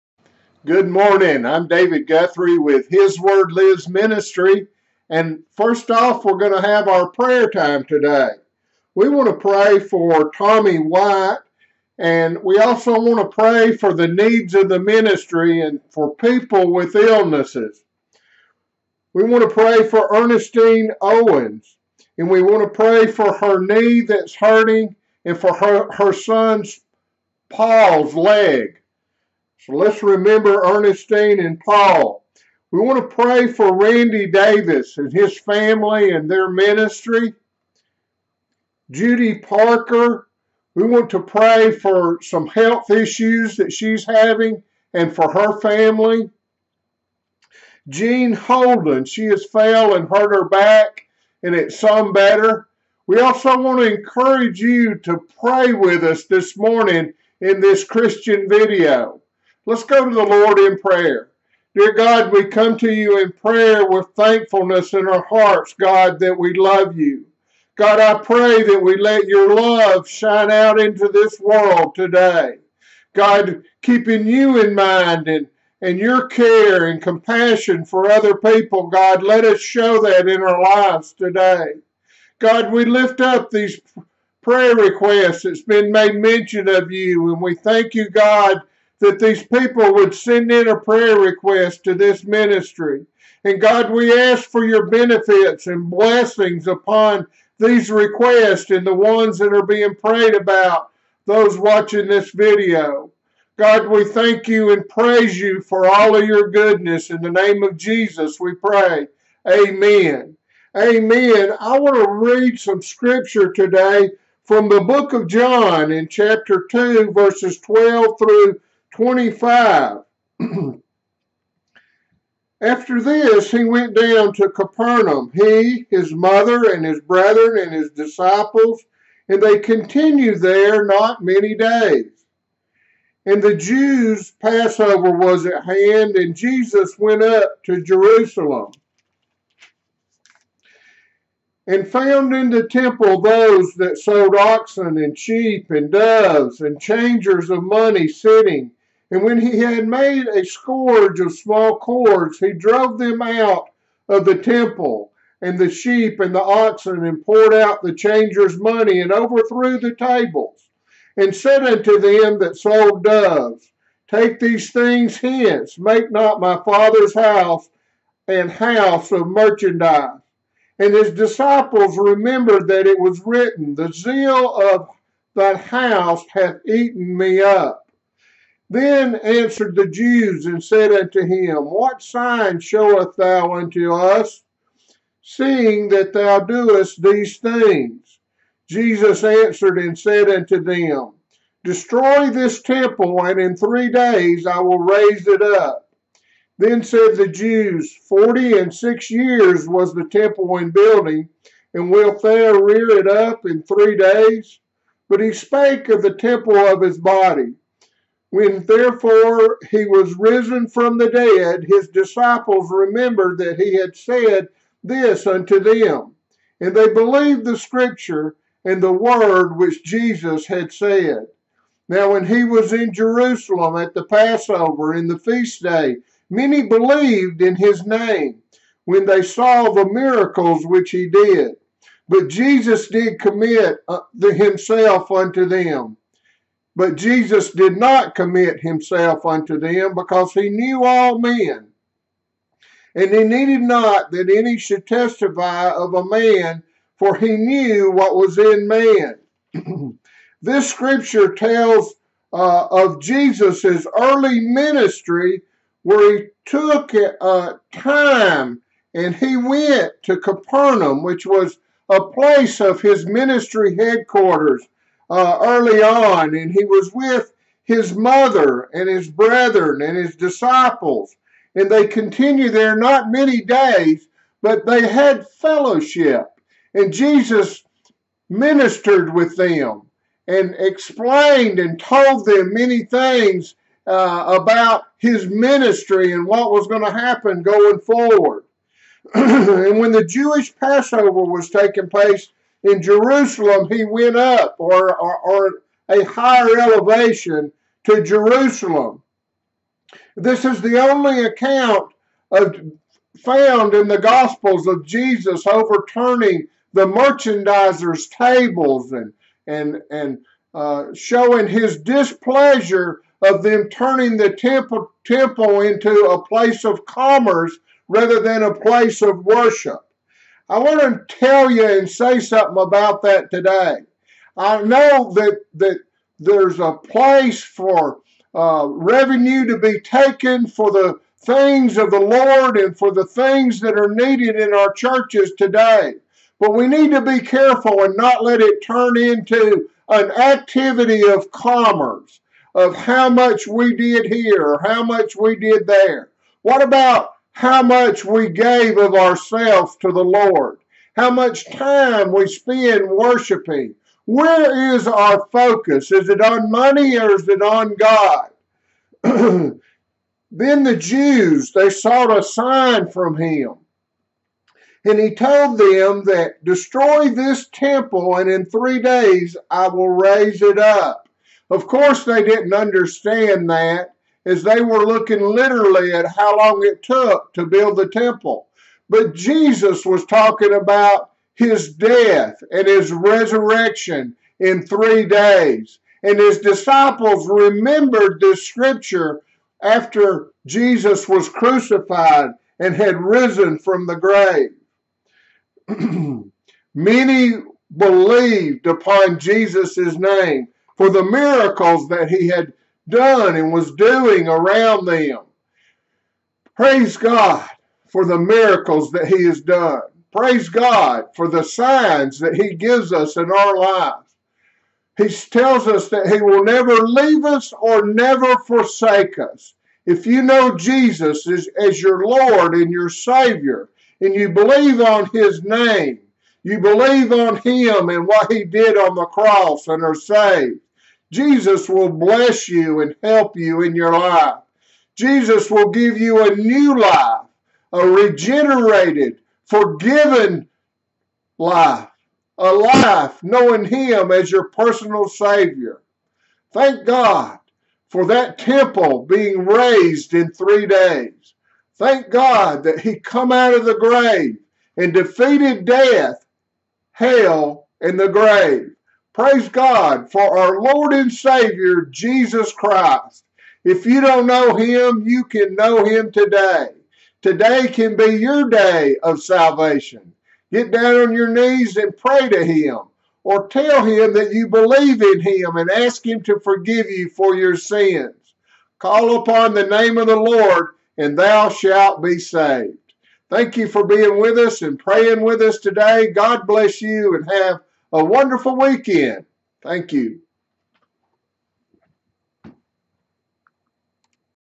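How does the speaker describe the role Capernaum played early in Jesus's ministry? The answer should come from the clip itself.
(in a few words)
ministry headquarters.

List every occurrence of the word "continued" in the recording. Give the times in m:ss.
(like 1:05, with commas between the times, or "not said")
2:09, 4:31.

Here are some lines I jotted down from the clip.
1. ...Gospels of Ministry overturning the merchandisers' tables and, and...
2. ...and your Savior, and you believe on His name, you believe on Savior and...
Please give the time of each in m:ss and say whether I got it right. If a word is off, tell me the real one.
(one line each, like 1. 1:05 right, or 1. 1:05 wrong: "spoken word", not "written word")
1. 5:03 wrong: "Jesus", not "Ministry"
2. 7:02 wrong: "Him", not "Savior".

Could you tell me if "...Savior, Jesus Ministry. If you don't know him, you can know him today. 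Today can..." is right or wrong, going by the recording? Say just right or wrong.
wrong.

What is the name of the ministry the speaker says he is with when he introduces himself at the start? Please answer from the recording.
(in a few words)
His Word Lives Ministry.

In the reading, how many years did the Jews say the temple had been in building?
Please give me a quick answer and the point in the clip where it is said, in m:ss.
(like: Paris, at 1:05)
46, at 3:18.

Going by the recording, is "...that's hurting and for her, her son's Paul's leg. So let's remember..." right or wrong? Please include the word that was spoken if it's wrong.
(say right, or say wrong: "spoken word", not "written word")
right.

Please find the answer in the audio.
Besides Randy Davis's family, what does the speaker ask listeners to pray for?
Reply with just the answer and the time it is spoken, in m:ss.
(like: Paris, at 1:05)
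their ministry, at 0:36.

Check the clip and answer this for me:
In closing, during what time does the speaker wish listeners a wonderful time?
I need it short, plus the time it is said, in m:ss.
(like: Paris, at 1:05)
weekend, at 8:08.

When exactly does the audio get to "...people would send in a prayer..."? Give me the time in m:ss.
1:29.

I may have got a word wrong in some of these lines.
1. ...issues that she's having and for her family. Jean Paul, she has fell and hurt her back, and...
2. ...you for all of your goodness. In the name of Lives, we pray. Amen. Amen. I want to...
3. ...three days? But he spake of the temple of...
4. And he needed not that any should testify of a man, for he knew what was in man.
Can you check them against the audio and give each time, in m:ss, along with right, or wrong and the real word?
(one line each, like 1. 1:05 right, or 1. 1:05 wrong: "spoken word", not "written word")
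1. 0:42 wrong: "Holden", not "Paul"
2. 1:45 wrong: "Jesus", not "Lives"
3. 3:23 right
4. 4:02 right.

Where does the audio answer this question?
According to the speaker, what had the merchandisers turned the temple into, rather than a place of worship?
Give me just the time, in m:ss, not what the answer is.
5:16.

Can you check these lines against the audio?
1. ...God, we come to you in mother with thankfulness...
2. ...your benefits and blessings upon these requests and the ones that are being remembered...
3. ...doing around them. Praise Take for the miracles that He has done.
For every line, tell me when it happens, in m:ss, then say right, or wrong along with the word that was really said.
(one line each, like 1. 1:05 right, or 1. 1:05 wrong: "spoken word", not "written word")
1. 1:01 wrong: "prayer", not "mother"
2. 1:34 wrong: "prayed", not "remembered"
3. 6:43 wrong: "God", not "Take".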